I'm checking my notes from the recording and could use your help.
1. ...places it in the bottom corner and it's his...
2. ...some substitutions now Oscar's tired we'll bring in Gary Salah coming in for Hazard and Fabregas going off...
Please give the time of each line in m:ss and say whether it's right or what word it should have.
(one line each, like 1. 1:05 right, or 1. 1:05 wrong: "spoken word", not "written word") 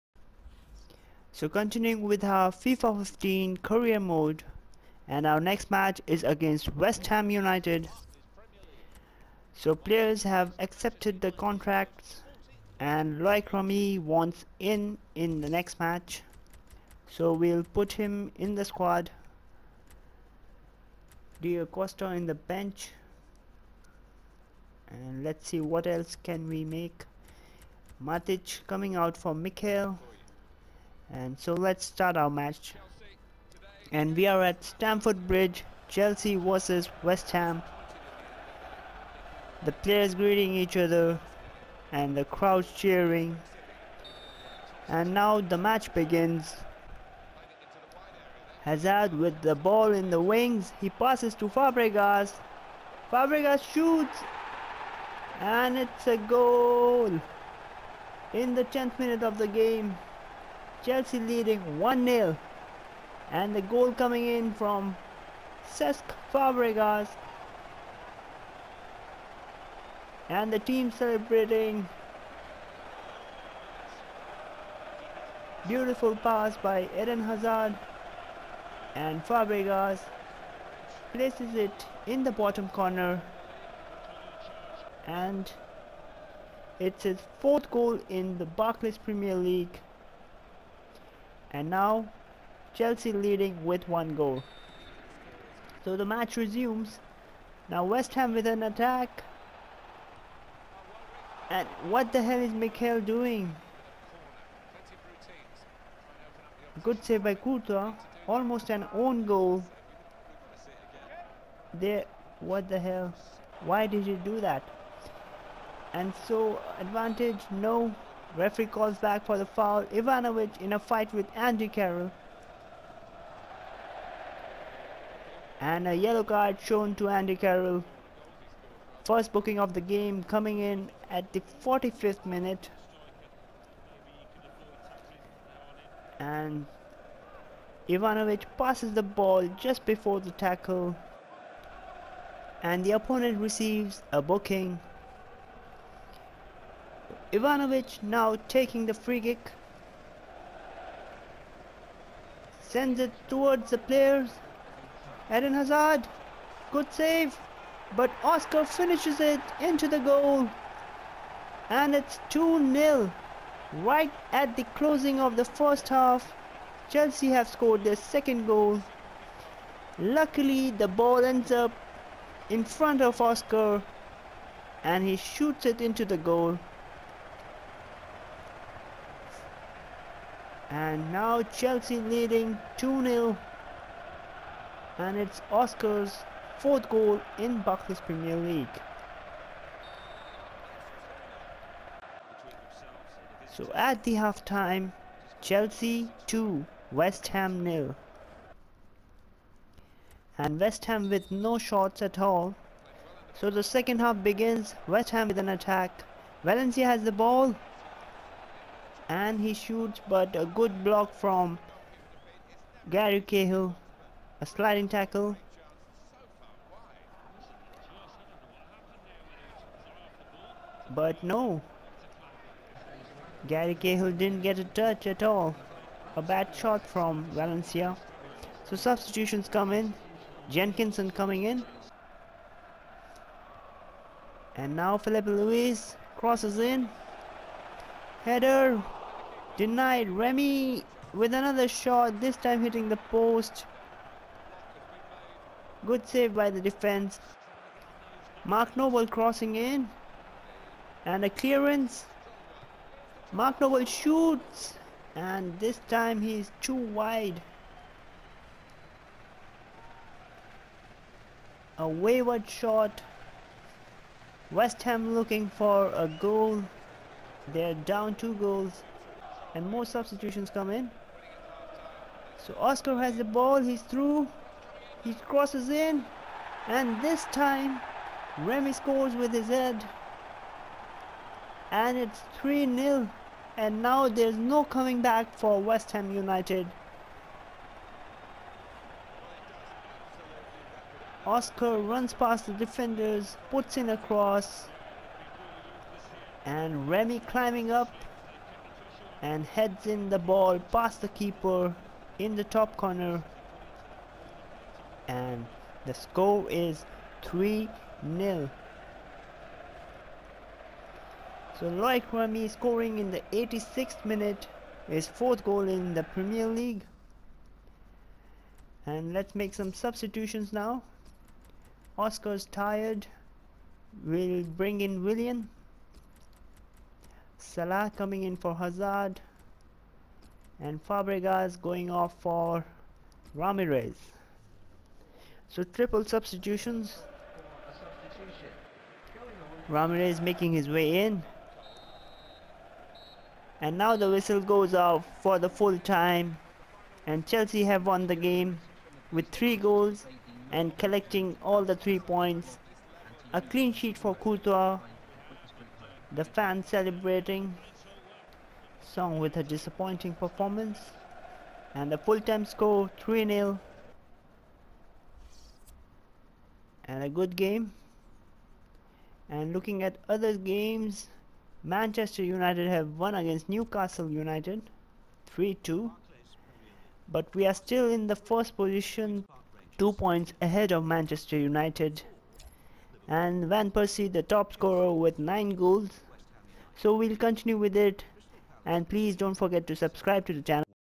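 1. 1:21 right
2. 5:19 wrong: "Willian", not "Gary".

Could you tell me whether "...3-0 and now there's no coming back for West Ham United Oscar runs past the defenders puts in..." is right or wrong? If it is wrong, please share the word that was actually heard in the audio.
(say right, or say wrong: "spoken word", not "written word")
right.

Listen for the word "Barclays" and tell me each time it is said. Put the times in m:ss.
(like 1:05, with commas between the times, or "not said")
1:28, 3:07.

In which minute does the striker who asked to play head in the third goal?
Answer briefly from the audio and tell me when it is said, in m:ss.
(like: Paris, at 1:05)
86th minute, at 5:13.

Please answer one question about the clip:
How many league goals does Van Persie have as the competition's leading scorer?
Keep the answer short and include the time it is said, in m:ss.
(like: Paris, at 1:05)
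9, at 6:25.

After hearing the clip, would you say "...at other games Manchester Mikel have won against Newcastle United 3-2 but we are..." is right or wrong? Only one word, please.
wrong.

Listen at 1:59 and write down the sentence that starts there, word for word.
Ivanovic in a fight with Andy Carroll.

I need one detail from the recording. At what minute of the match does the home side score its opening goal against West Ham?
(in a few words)
10th minute.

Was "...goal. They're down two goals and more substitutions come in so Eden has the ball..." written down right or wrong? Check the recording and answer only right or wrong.
wrong.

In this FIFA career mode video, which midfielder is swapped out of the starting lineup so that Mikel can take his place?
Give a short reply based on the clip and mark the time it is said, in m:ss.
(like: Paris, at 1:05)
Matic, at 0:27.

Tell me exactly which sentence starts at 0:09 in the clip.
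So players have accepted the contracts and Loic Remy wants in in the next match.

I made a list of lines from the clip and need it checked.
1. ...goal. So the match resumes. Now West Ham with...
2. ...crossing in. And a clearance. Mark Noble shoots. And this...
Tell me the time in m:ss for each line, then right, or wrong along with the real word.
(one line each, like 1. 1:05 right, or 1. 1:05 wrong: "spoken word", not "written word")
1. 1:34 right
2. 4:09 right.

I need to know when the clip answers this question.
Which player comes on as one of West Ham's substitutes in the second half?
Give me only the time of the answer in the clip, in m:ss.
3:50.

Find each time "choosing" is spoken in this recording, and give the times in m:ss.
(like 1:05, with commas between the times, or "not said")
not said.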